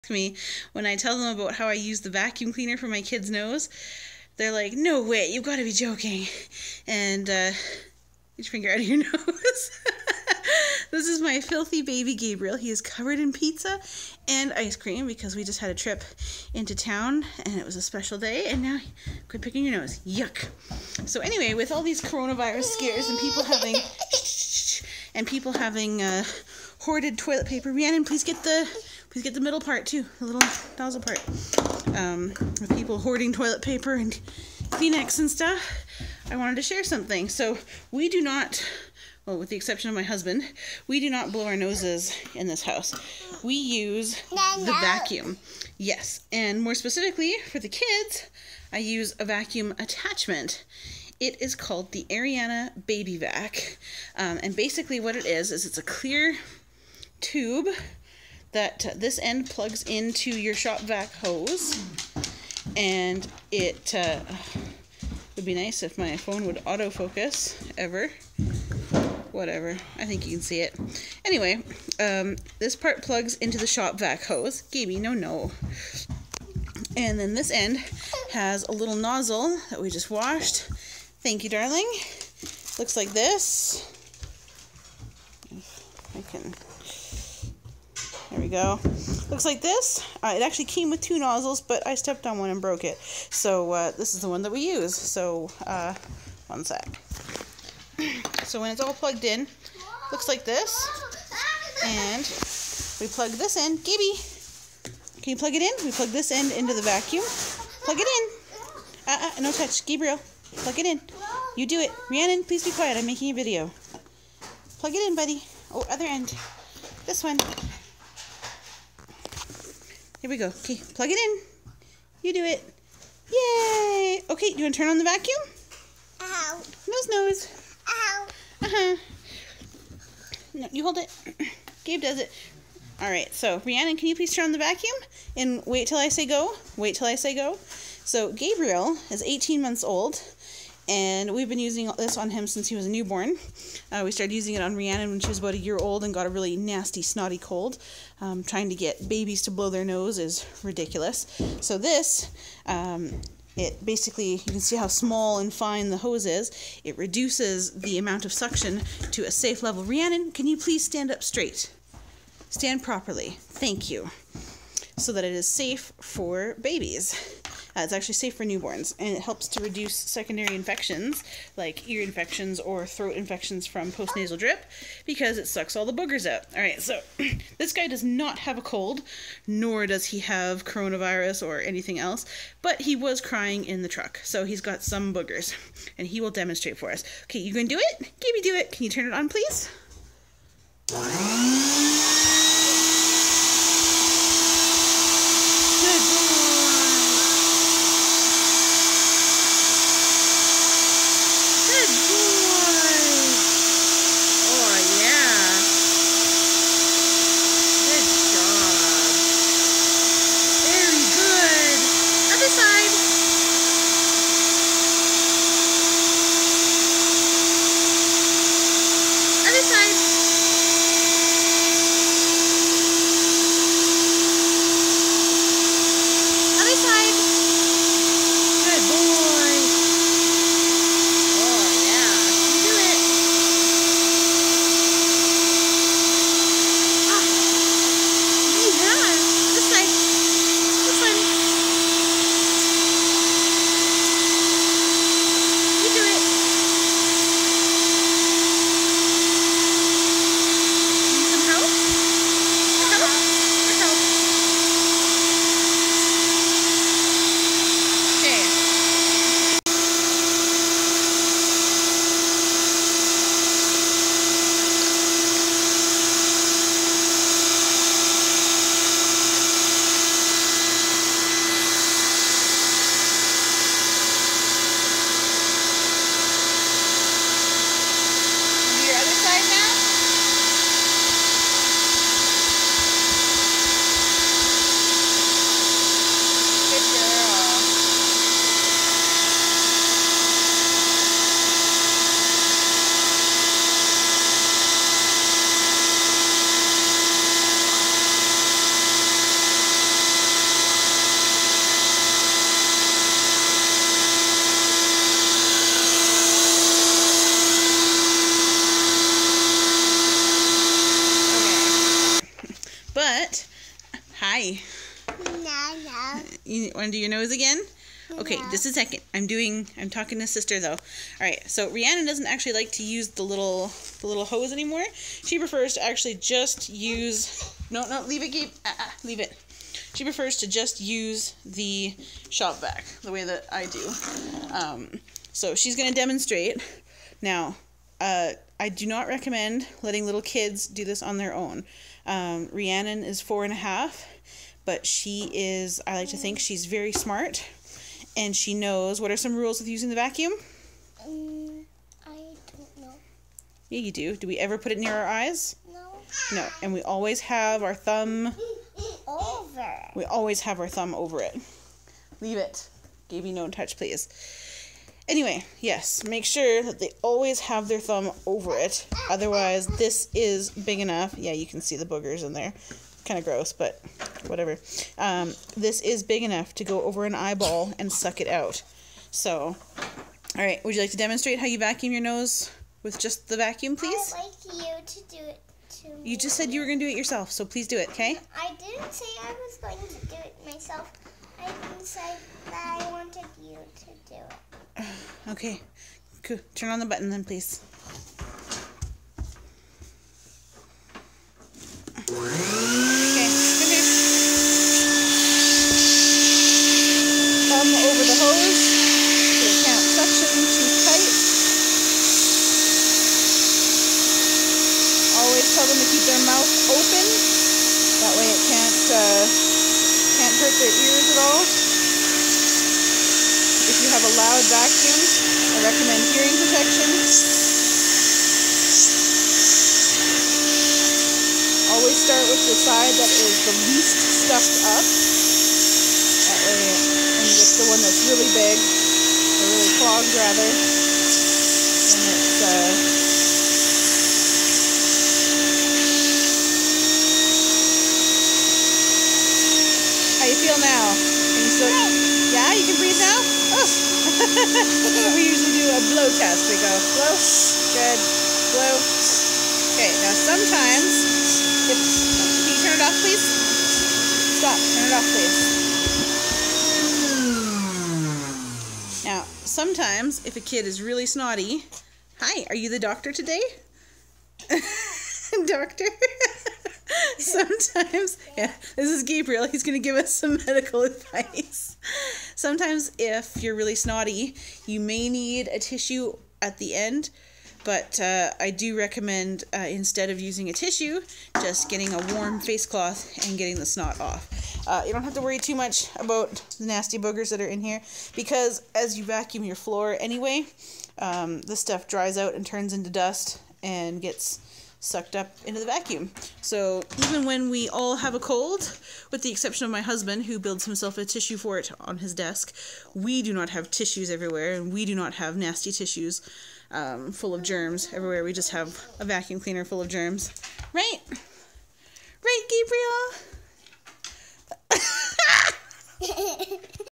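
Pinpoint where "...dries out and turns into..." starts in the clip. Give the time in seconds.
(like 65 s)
501 s.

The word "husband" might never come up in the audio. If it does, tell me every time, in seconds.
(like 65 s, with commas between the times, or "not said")
40 s, 509 s.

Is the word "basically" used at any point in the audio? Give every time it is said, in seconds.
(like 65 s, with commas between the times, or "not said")
54 s, 153 s.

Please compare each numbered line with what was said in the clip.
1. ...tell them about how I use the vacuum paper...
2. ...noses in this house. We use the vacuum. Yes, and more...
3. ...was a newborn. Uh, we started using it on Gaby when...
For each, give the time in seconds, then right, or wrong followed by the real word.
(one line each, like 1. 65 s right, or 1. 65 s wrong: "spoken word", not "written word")
1. 0 s wrong: "cleaner", not "paper"
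2. 41 s right
3. 142 s wrong: "Rhiannon", not "Gaby".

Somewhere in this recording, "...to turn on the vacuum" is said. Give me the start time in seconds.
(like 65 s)
124 s.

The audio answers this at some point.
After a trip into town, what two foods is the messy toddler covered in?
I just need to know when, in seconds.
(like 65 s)
13 s.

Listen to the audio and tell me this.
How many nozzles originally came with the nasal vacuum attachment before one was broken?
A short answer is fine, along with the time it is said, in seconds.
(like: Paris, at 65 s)
2, at 91 s.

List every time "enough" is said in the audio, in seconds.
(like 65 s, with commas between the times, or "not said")
370 s, 376 s.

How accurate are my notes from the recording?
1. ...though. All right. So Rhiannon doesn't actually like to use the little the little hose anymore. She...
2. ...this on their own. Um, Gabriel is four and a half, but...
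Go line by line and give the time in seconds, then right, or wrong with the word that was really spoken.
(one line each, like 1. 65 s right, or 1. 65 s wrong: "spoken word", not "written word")
1. 320 s right
2. 340 s wrong: "Rhiannon", not "Gabriel".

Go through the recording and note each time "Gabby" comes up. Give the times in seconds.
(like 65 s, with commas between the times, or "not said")
363 s.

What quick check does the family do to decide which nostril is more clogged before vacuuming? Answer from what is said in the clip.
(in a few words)
blow test.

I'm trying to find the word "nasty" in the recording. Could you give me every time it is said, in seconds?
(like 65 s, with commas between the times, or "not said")
146 s, 496 s, 515 s.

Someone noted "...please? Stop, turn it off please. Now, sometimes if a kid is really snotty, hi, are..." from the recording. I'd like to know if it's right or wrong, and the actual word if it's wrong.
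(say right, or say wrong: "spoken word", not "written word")
right.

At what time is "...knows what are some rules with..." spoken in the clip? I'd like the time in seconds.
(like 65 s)
348 s.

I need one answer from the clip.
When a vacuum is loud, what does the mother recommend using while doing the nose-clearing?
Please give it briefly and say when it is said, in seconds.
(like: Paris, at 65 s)
hearing protection, at 426 s.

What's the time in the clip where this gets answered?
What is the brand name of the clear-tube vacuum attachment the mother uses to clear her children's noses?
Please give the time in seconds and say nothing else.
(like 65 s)
52 s.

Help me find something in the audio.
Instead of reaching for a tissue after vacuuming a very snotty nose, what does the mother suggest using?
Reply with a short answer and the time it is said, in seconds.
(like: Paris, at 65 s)
warm face cloth, at 492 s.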